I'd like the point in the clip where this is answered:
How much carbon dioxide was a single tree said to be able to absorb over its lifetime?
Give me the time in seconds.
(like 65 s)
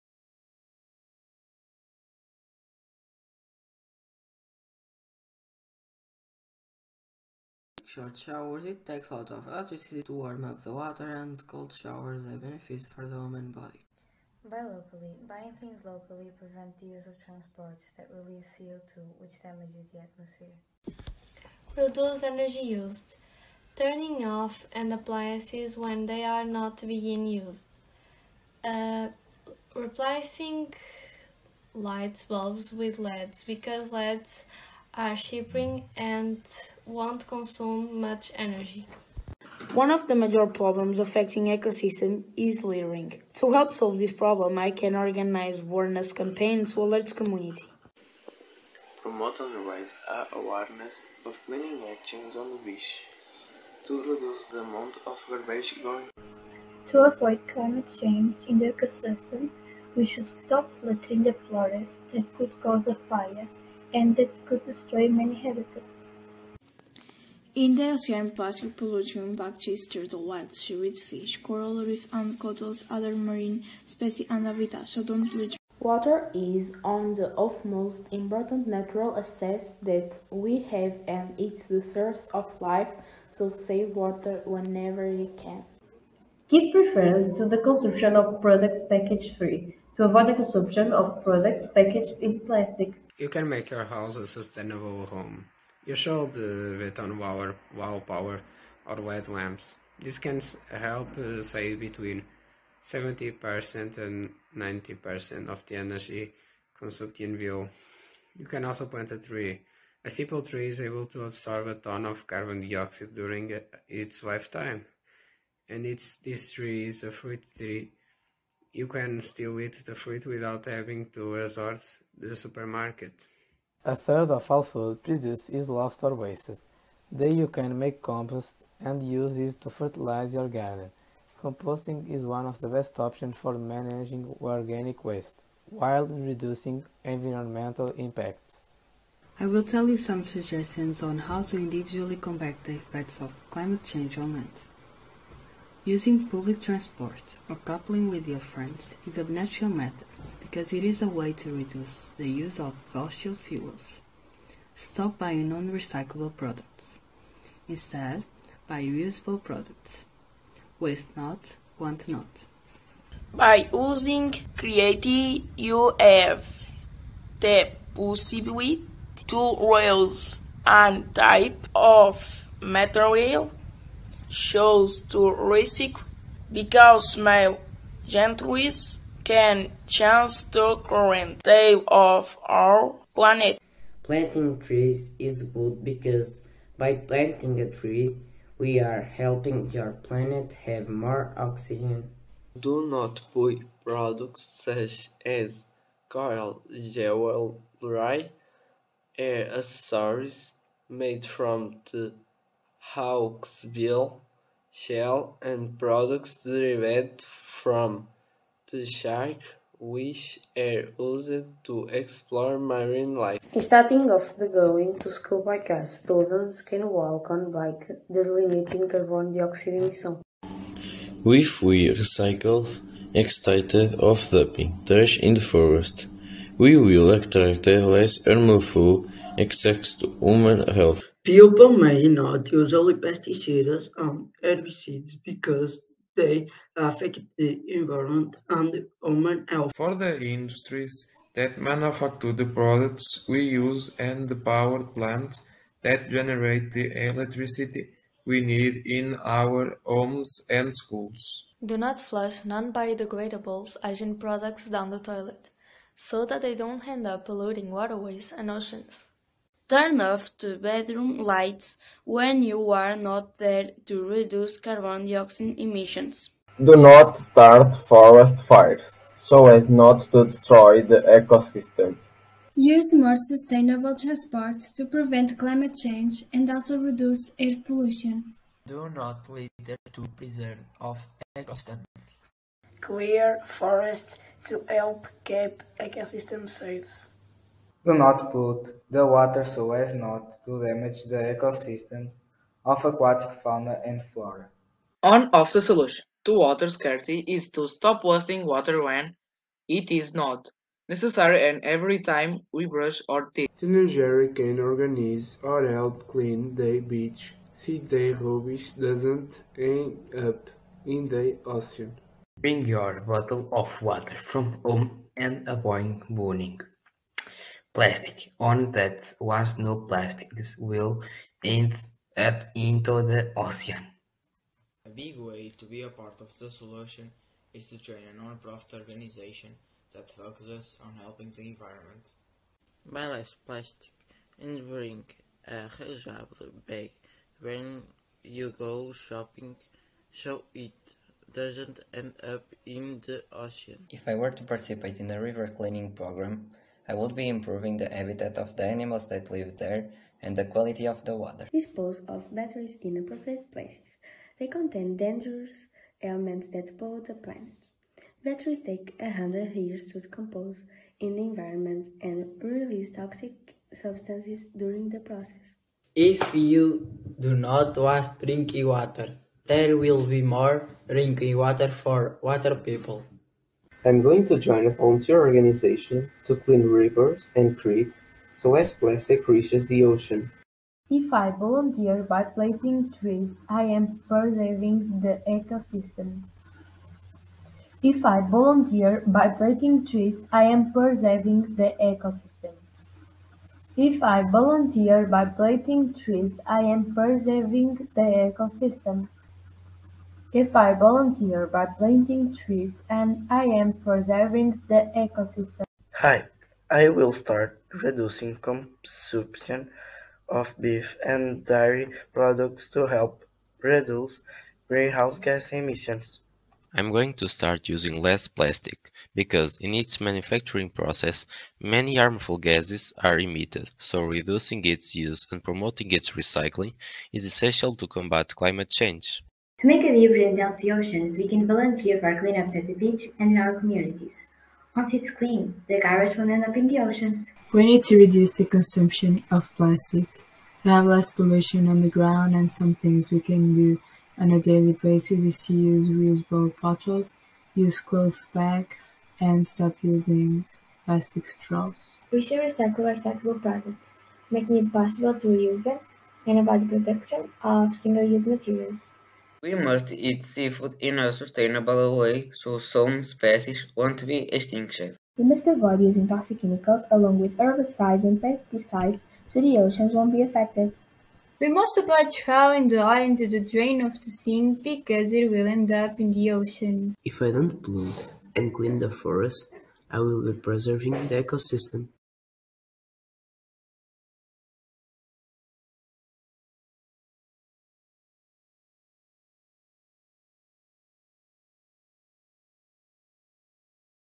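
111 s.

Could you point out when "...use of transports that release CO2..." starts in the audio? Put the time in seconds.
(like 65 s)
16 s.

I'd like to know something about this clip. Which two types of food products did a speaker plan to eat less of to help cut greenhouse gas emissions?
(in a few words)
beef and dairy.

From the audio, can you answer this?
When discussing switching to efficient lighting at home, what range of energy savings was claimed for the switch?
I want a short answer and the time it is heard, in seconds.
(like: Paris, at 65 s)
70% to 90%, at 102 s.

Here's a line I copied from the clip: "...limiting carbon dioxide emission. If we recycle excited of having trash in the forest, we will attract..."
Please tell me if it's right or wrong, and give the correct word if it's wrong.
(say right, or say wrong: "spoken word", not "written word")
wrong: "dumping", not "having".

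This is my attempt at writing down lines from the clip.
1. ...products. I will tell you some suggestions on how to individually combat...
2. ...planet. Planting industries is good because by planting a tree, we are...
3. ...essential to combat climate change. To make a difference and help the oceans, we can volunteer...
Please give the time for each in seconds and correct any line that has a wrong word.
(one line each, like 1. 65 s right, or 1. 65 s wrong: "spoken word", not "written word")
1. 137 s wrong: "impacts", not "products"
2. 183 s wrong: "trees", not "industries"
3. 427 s right.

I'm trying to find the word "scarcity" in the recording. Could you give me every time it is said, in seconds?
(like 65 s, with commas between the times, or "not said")
296 s.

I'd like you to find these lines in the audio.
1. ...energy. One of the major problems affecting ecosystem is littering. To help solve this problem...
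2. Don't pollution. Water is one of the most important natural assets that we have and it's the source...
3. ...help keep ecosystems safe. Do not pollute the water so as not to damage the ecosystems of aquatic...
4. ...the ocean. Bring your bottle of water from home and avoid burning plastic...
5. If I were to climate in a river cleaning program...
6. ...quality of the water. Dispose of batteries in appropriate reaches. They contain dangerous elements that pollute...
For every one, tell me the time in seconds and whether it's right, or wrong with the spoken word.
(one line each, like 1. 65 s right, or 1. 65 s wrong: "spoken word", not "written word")
1. 38 s right
2. 74 s right
3. 284 s right
4. 311 s right
5. 343 s wrong: "participate", not "climate"
6. 350 s wrong: "places", not "reaches".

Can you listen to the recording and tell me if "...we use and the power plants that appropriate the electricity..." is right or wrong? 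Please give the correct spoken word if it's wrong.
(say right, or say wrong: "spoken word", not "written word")
wrong: "generate", not "appropriate".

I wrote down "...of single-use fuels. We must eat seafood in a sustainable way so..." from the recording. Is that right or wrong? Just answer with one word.
wrong.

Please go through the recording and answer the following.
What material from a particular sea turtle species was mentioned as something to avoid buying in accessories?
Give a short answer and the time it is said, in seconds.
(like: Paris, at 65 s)
Hawksbill shell, at 202 s.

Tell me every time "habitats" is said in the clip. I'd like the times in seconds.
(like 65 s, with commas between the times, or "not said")
65 s, 74 s, 347 s.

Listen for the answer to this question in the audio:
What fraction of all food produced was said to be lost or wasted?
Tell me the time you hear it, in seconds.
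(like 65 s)
123 s.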